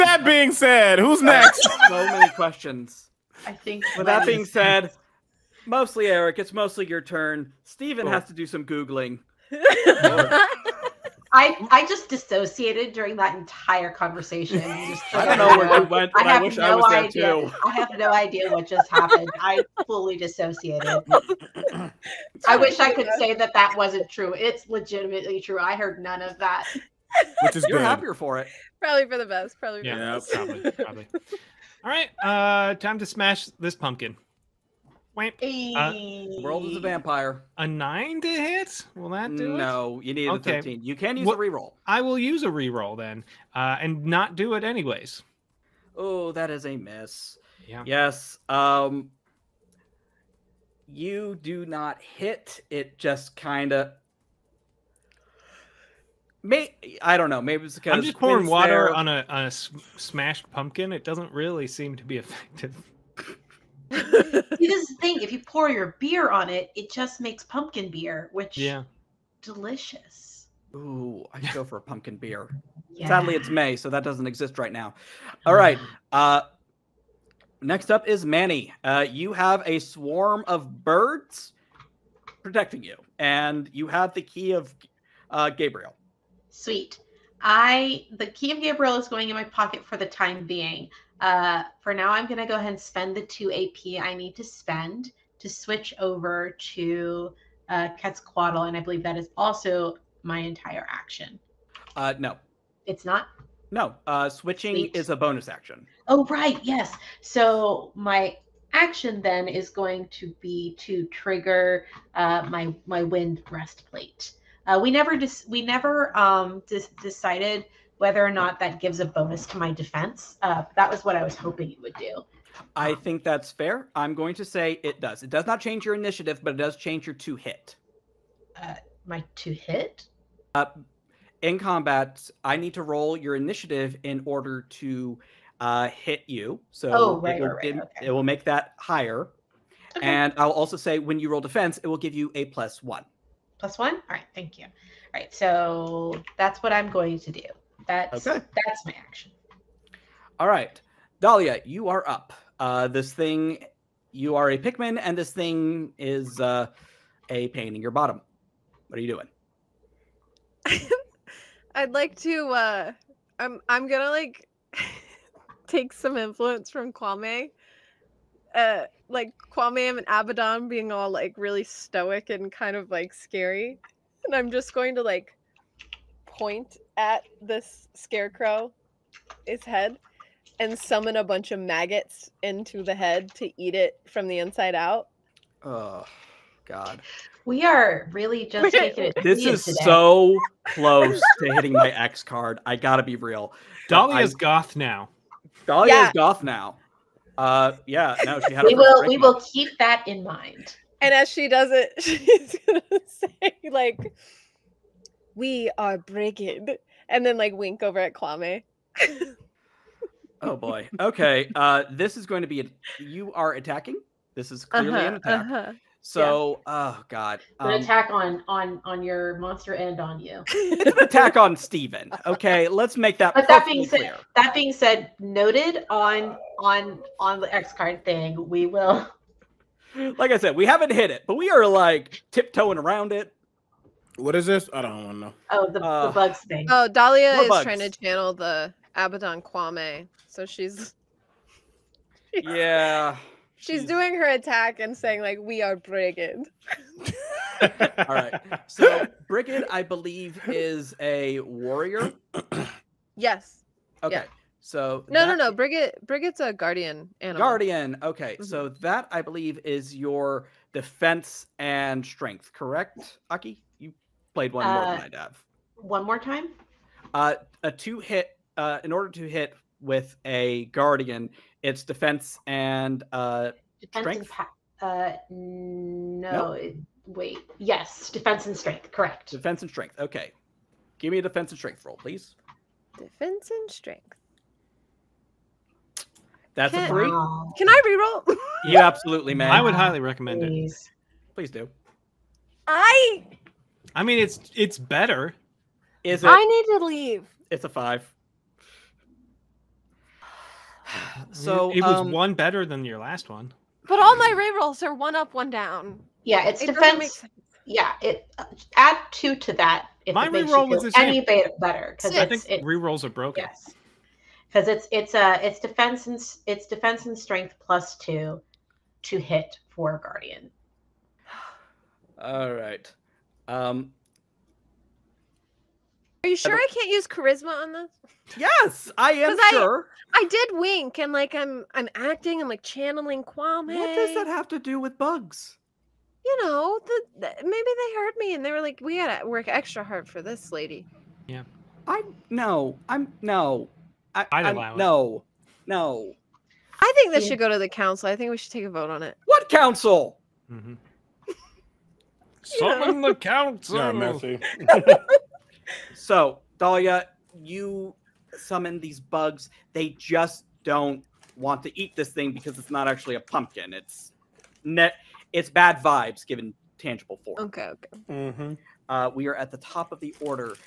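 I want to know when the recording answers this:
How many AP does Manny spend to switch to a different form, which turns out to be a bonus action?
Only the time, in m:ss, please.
1:33.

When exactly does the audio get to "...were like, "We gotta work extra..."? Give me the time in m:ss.
5:38.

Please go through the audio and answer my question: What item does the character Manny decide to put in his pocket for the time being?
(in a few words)
The key of Gabriel.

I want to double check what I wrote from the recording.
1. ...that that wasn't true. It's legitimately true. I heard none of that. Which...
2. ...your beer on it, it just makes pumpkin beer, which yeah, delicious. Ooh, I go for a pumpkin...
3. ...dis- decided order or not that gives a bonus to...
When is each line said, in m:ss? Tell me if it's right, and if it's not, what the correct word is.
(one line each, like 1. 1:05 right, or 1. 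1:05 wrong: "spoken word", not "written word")
1. 0:23 right
2. 1:05 right
3. 1:56 wrong: "whether", not "order".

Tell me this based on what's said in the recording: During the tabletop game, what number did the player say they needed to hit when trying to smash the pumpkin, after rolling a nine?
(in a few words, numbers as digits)
13.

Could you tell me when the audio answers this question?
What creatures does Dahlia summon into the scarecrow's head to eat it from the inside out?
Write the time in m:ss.
3:01.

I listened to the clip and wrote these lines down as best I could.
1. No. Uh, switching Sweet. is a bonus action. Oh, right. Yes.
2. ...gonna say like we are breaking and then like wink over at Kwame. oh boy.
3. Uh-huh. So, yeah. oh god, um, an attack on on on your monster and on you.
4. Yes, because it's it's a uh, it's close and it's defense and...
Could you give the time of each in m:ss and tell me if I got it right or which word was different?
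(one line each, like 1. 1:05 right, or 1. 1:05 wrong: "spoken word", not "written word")
1. 1:43 right
2. 3:22 right
3. 3:35 right
4. 5:13 wrong: "defense", not "close".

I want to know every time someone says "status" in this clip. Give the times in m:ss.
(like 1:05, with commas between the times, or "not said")
not said.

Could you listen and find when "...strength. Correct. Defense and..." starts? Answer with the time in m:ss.
4:38.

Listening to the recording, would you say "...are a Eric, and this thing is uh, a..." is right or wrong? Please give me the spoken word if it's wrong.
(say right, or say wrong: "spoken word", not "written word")
wrong: "Pikmin", not "Eric".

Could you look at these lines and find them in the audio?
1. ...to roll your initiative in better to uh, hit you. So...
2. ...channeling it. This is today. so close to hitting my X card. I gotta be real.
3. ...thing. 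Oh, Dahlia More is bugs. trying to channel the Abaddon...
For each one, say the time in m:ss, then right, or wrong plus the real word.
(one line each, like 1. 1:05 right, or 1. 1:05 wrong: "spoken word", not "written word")
1. 2:12 wrong: "order", not "better"
2. 3:08 wrong: "taking", not "channeling"
3. 3:56 right.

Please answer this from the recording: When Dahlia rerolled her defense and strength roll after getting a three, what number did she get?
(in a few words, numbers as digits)
5.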